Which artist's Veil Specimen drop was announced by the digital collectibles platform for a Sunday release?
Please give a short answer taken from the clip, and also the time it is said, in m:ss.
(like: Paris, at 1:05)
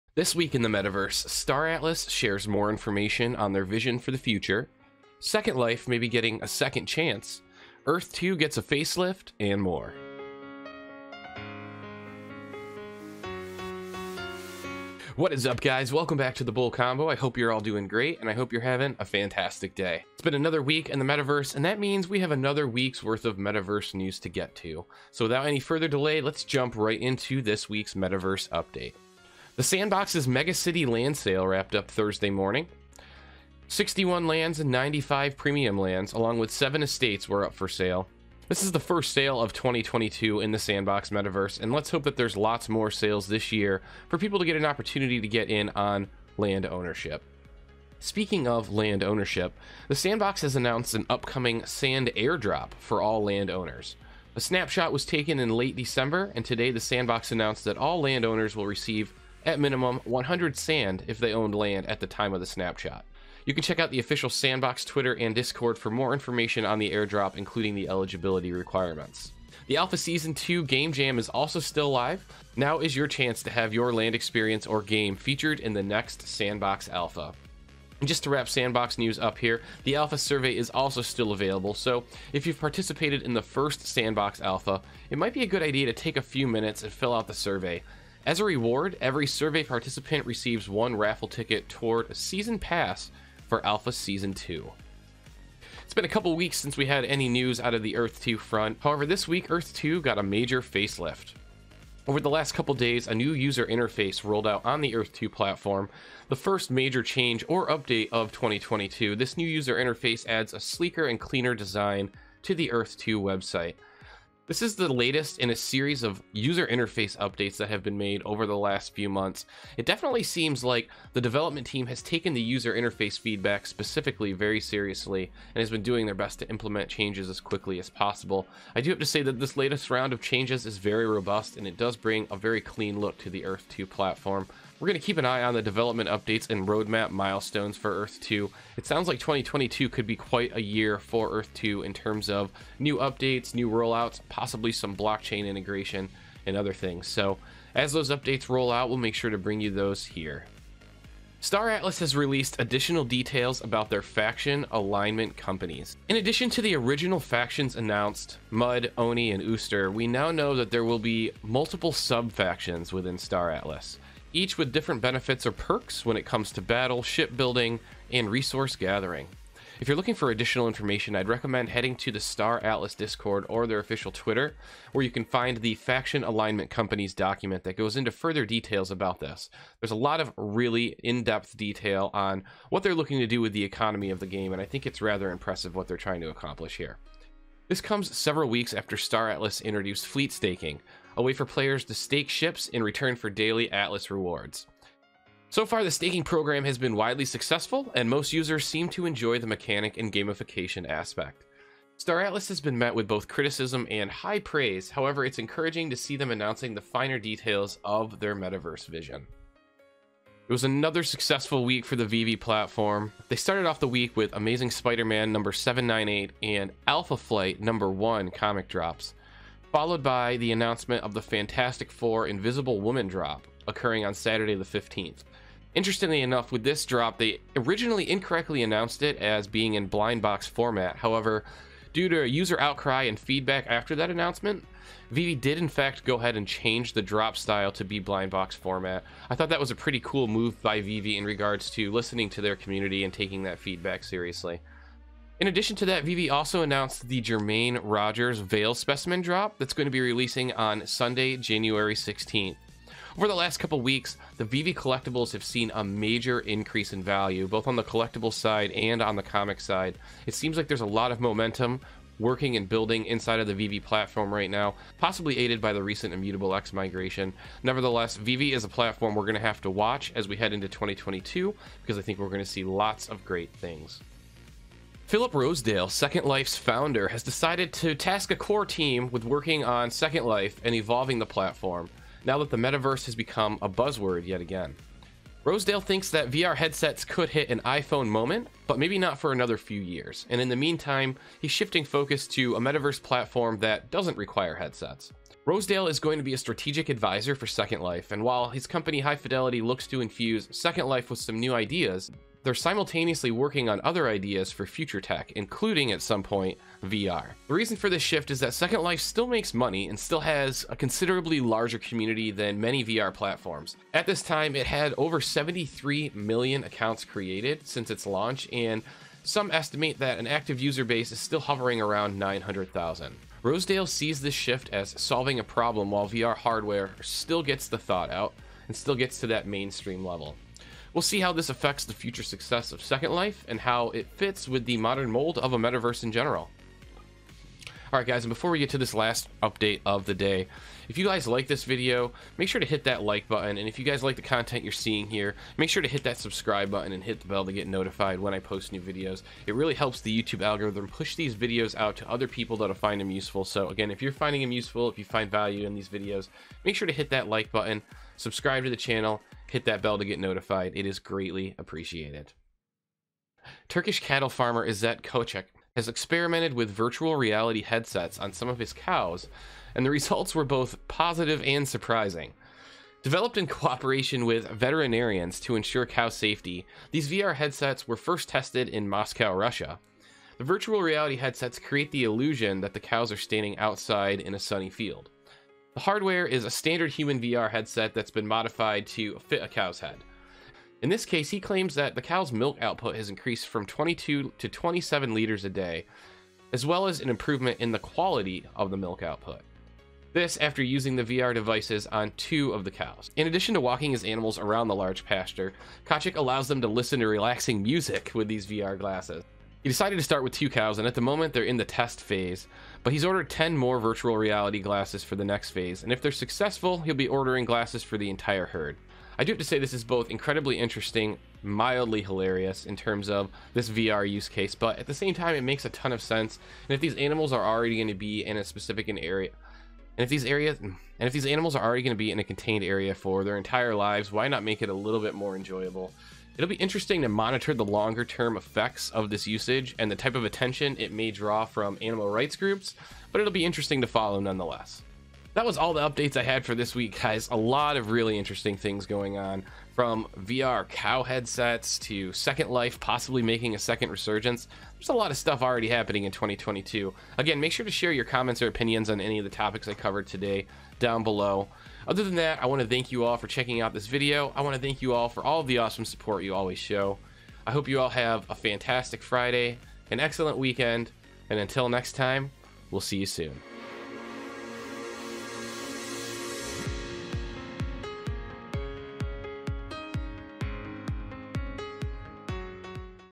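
Jermaine Rogers, at 4:07.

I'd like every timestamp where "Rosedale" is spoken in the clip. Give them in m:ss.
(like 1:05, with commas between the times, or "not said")
4:35, 4:45, 4:55, 5:23.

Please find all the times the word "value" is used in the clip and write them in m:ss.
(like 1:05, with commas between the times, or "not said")
4:17, 5:55.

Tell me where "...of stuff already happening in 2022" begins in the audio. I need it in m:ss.
7:35.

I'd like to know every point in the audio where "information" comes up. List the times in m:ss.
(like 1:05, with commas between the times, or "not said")
0:02, 1:06, 2:50.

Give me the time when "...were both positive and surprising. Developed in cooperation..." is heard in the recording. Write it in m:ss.
6:10.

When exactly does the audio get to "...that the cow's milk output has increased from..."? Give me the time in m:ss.
6:31.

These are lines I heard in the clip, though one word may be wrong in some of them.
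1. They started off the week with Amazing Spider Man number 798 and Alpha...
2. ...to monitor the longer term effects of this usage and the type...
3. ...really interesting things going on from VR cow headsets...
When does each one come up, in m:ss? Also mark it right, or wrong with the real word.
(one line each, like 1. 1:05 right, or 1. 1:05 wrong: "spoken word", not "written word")
1. 3:33 right
2. 7:17 right
3. 7:27 right.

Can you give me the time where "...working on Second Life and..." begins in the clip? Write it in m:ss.
4:39.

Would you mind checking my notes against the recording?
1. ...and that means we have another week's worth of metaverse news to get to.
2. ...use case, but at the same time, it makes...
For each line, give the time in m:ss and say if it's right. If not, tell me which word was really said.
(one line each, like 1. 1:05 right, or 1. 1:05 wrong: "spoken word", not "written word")
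1. 0:21 right
2. 7:04 right.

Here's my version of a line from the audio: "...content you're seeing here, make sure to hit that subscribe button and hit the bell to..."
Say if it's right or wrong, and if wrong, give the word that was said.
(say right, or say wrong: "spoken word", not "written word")
right.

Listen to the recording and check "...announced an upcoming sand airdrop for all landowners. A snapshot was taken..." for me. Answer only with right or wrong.
right.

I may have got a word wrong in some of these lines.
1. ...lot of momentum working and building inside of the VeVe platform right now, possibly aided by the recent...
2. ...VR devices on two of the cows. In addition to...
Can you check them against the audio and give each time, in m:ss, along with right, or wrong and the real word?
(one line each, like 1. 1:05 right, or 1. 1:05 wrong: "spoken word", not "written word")
1. 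4:20 right
2. 6:41 right.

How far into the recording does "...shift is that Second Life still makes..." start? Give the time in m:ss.
5:08.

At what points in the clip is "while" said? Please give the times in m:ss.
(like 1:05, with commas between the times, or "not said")
4:58, 5:25.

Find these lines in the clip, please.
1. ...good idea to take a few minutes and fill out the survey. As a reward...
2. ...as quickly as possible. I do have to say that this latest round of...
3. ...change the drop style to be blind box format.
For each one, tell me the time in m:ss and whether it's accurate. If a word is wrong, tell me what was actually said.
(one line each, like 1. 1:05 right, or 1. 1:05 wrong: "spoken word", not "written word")
1. 1:25 right
2. 2:07 right
3. 3:56 right.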